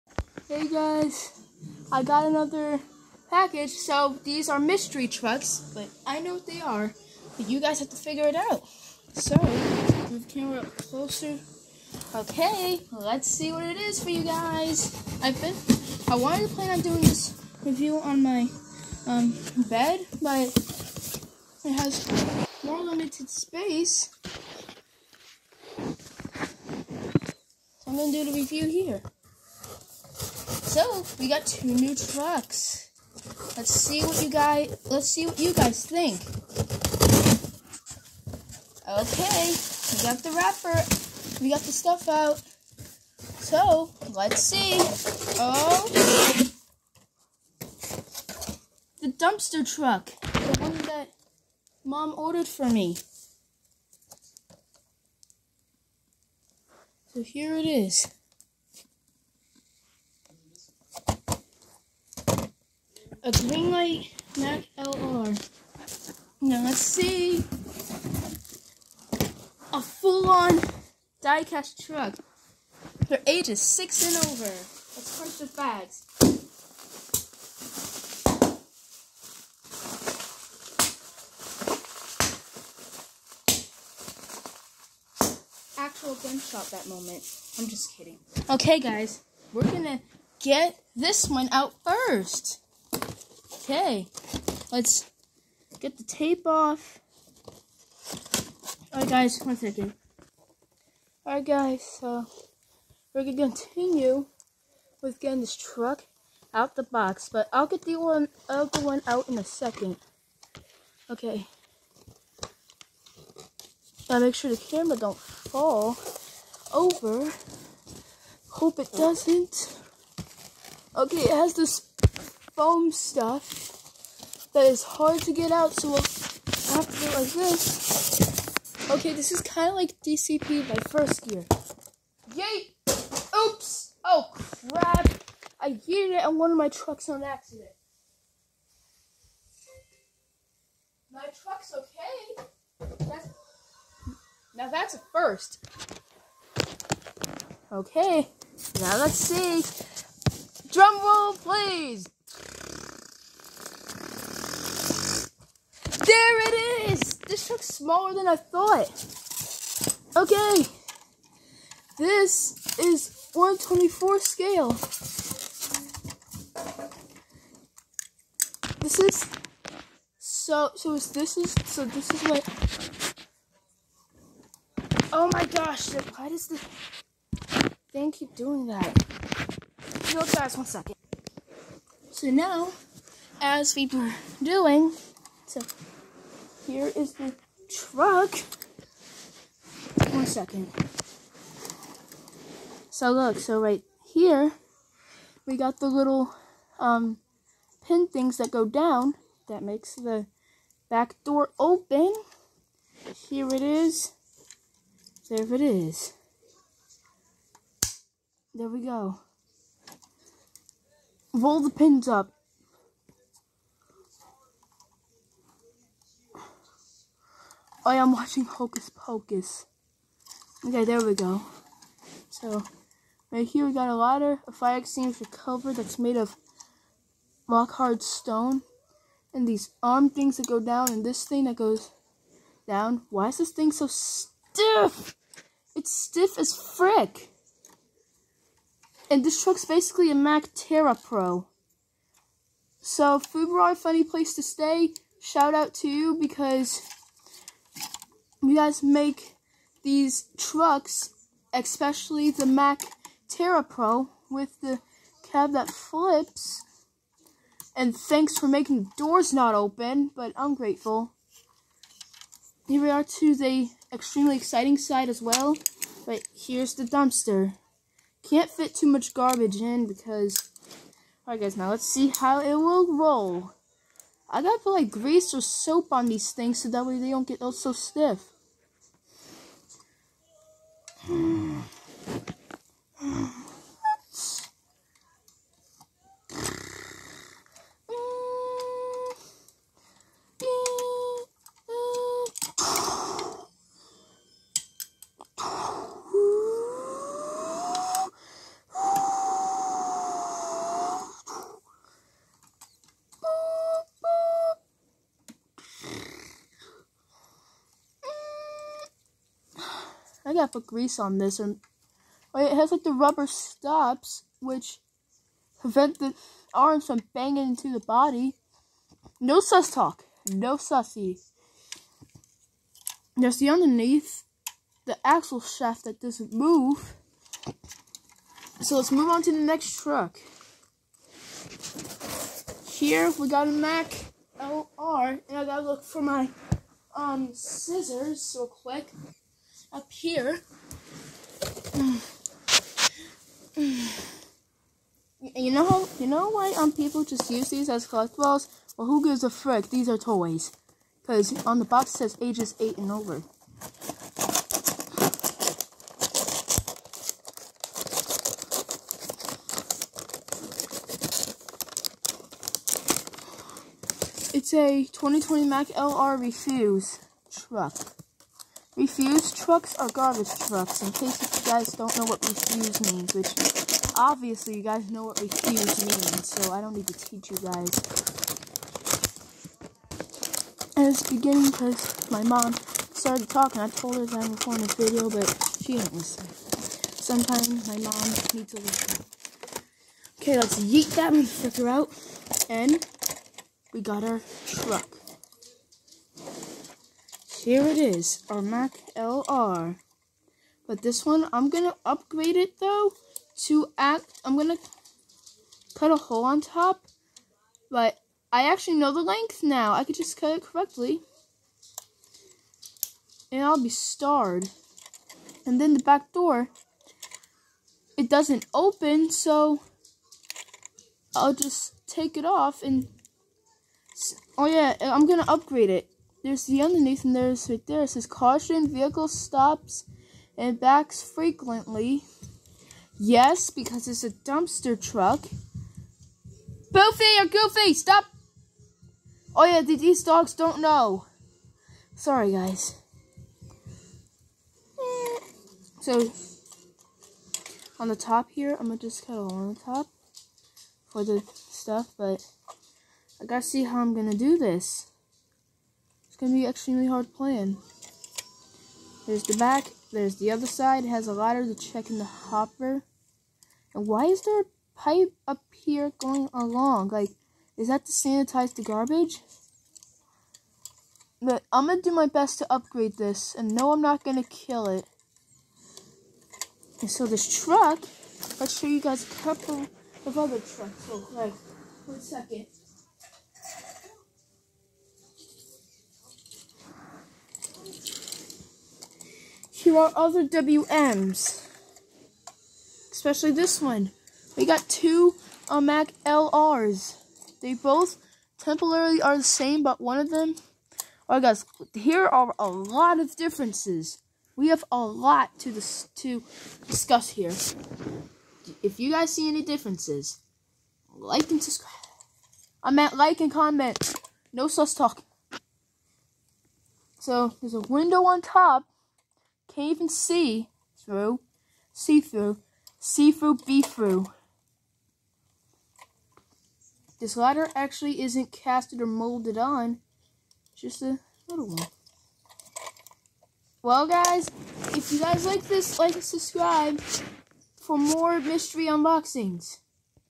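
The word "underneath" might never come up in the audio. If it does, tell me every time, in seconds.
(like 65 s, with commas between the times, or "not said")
323 s, 426 s.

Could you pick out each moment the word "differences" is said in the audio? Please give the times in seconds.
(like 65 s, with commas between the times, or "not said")
503 s, 509 s.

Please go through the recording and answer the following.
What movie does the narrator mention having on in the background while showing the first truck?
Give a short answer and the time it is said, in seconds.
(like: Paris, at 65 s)
Hocus Pocus, at 218 s.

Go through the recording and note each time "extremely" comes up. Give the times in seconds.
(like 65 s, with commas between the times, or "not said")
263 s, 456 s.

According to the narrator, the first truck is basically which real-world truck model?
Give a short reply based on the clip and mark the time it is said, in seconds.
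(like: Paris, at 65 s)
Mack TerraPro, at 240 s.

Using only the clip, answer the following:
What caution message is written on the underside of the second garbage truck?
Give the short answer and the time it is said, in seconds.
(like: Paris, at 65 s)
vehicle stops and backs frequently, at 428 s.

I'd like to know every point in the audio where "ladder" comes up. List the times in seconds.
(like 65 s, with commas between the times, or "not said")
223 s, 461 s, 527 s.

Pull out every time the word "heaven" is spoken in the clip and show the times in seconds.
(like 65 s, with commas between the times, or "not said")
not said.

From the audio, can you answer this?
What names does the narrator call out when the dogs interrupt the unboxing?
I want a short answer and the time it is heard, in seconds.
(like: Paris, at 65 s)
Boofy or Goofy, at 436 s.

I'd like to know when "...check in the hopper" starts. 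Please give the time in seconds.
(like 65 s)
461 s.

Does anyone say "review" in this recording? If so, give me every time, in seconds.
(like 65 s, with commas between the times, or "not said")
17 s, 28 s.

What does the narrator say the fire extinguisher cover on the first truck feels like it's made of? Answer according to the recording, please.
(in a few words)
rock hard stone.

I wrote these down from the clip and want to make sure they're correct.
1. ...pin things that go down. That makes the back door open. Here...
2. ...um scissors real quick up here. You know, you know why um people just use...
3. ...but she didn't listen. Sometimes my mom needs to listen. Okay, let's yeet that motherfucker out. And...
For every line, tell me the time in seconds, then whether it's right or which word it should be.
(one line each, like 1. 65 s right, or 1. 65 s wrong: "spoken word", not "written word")
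1. 197 s right
2. 336 s right
3. 385 s right.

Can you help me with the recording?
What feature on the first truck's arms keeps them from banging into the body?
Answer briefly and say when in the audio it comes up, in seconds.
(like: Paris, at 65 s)
rubber stops, at 312 s.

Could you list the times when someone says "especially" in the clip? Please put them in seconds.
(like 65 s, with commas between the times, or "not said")
251 s, 492 s.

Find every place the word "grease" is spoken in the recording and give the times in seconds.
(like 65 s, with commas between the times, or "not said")
274 s, 310 s.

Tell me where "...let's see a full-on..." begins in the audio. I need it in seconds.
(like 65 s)
66 s.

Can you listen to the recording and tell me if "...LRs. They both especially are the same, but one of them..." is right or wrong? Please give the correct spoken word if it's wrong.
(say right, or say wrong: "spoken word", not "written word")
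wrong: "temporarily", not "especially".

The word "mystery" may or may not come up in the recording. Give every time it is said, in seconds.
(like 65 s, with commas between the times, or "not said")
4 s, 538 s.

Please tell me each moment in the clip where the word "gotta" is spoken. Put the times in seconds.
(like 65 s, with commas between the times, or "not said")
114 s, 274 s, 310 s, 335 s, 453 s.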